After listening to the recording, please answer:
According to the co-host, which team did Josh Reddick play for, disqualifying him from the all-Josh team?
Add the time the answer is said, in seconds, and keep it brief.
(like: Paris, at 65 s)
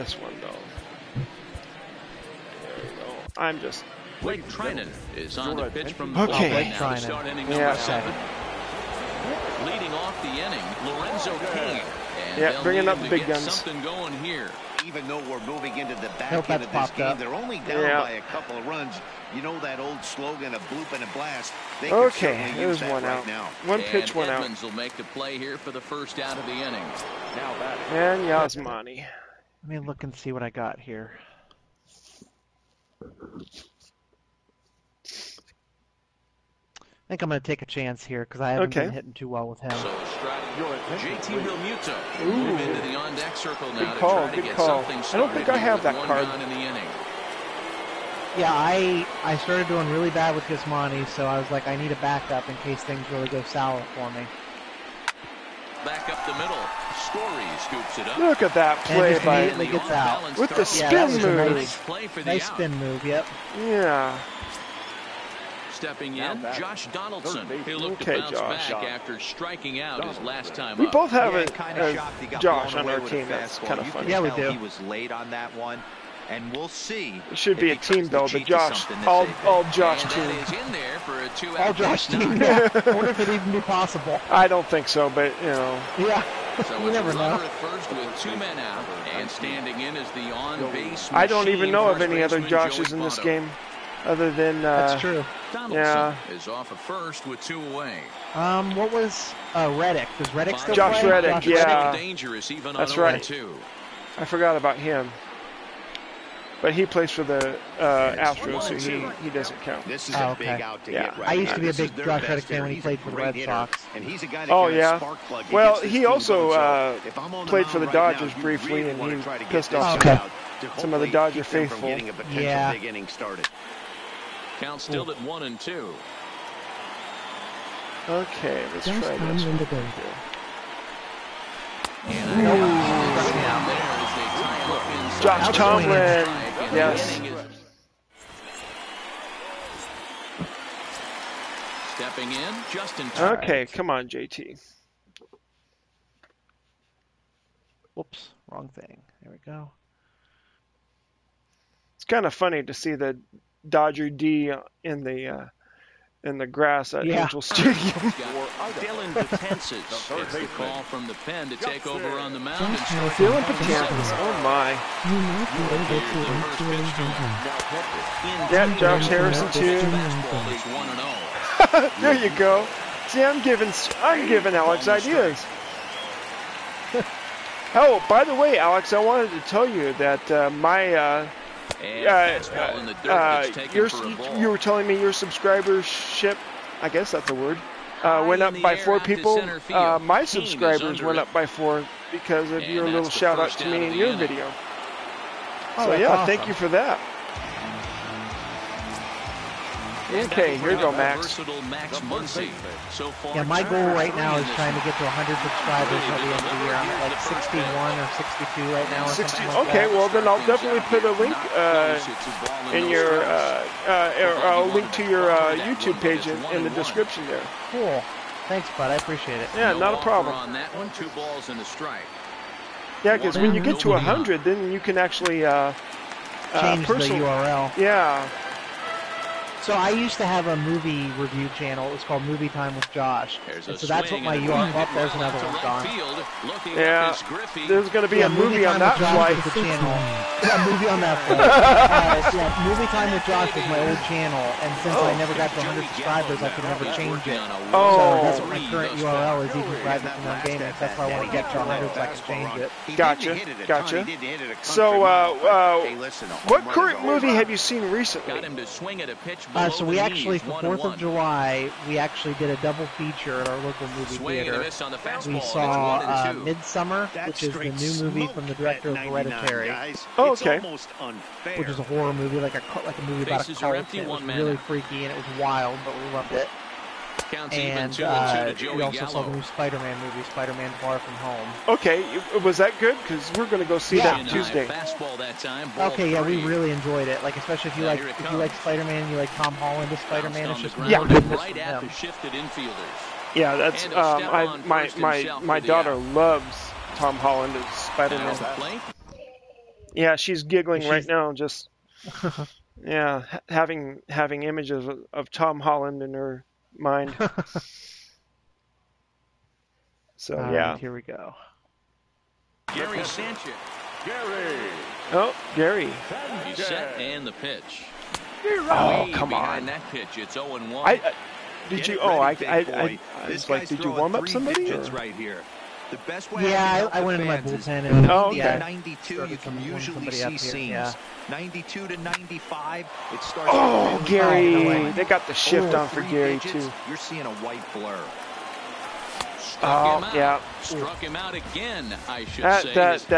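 Astros, at 106 s.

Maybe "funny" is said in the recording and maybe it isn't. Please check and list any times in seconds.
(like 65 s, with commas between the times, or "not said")
73 s, 152 s.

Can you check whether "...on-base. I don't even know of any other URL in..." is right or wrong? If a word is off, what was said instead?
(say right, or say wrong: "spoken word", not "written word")
wrong: "Joshes", not "URL".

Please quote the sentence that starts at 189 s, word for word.
Uh, my subscribers went up by four because of and your little shout out to me in your video.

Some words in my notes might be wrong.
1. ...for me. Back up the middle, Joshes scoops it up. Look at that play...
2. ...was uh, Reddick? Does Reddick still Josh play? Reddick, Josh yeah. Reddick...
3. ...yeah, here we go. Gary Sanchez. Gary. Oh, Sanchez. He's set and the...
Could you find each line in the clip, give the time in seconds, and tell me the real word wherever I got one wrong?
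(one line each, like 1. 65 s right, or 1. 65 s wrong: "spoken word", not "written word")
1. 53 s wrong: "Story", not "Joshes"
2. 98 s right
3. 310 s wrong: "Gary", not "Sanchez".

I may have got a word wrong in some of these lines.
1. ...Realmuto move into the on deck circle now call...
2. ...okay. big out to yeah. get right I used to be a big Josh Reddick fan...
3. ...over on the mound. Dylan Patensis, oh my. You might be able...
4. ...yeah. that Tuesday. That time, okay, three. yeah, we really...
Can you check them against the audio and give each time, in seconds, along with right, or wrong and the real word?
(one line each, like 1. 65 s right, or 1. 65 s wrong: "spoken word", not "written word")
1. 41 s right
2. 110 s right
3. 161 s right
4. 283 s right.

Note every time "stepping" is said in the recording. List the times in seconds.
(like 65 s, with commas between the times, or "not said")
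65 s, 141 s.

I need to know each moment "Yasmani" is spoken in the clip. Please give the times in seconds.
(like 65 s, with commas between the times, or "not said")
28 s, 50 s.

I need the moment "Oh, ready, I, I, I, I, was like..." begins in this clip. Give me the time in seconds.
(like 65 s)
322 s.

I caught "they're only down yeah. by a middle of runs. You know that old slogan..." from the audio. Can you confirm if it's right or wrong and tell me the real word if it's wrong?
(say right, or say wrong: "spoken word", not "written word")
wrong: "couple", not "middle".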